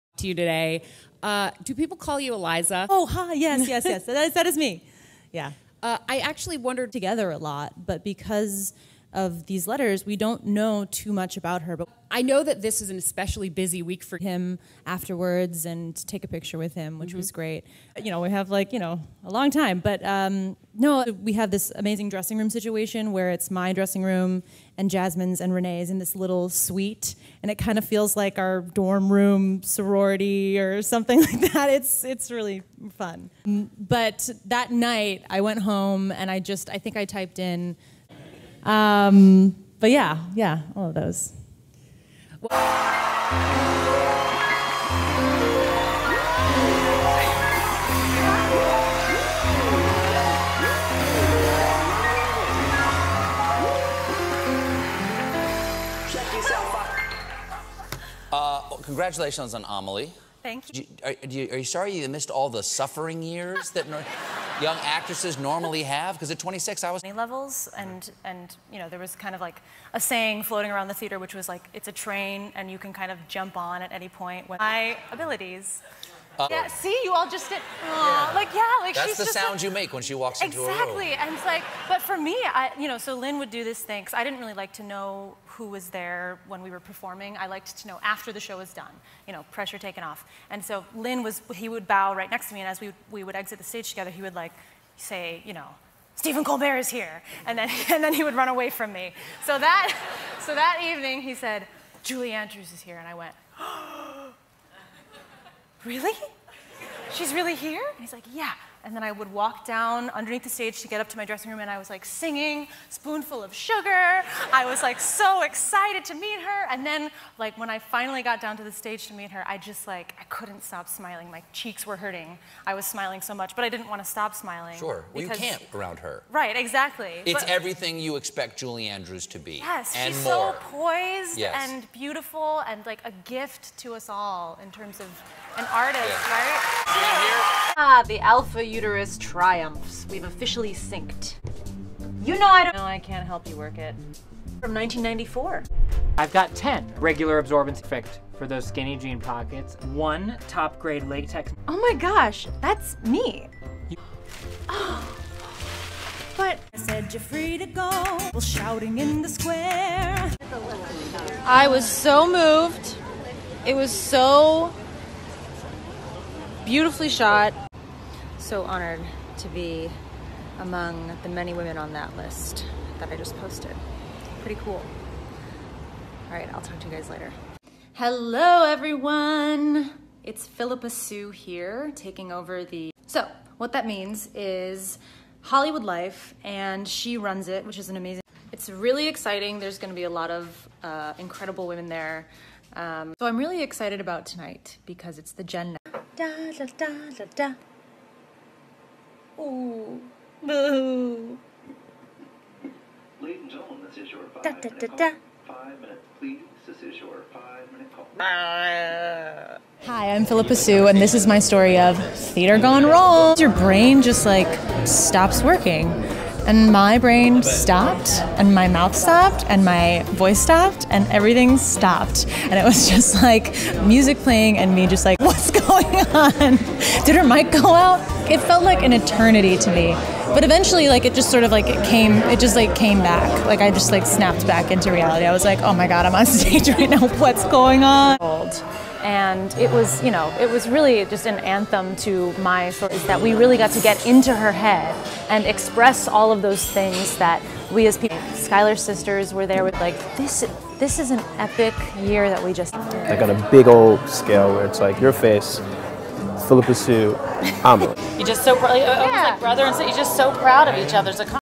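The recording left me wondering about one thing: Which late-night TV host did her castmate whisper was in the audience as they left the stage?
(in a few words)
Stephen Colbert.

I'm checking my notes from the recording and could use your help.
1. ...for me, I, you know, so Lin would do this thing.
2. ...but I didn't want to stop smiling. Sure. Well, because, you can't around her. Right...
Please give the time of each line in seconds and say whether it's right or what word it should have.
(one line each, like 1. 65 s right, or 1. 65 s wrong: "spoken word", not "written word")
1. 82 s right
2. 123 s right.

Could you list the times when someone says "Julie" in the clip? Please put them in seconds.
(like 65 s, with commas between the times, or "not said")
102 s, 128 s.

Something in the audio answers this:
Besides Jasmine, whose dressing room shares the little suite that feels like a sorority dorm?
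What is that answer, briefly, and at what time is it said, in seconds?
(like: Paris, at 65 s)
Renee, at 25 s.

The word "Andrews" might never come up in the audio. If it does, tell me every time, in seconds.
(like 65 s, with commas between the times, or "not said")
102 s, 128 s.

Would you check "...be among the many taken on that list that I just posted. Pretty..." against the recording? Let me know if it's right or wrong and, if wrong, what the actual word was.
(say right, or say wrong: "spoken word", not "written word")
wrong: "women", not "taken".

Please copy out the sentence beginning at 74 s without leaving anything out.
My abilities yeah, see, you all just did.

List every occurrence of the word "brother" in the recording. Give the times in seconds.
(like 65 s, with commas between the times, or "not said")
259 s.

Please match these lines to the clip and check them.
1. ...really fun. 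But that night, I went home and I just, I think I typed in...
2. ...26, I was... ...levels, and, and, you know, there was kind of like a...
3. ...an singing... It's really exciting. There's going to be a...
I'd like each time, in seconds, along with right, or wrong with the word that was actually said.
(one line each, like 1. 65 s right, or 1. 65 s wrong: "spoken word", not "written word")
1. 32 s right
2. 66 s right
3. 187 s wrong: "amazing", not "singing".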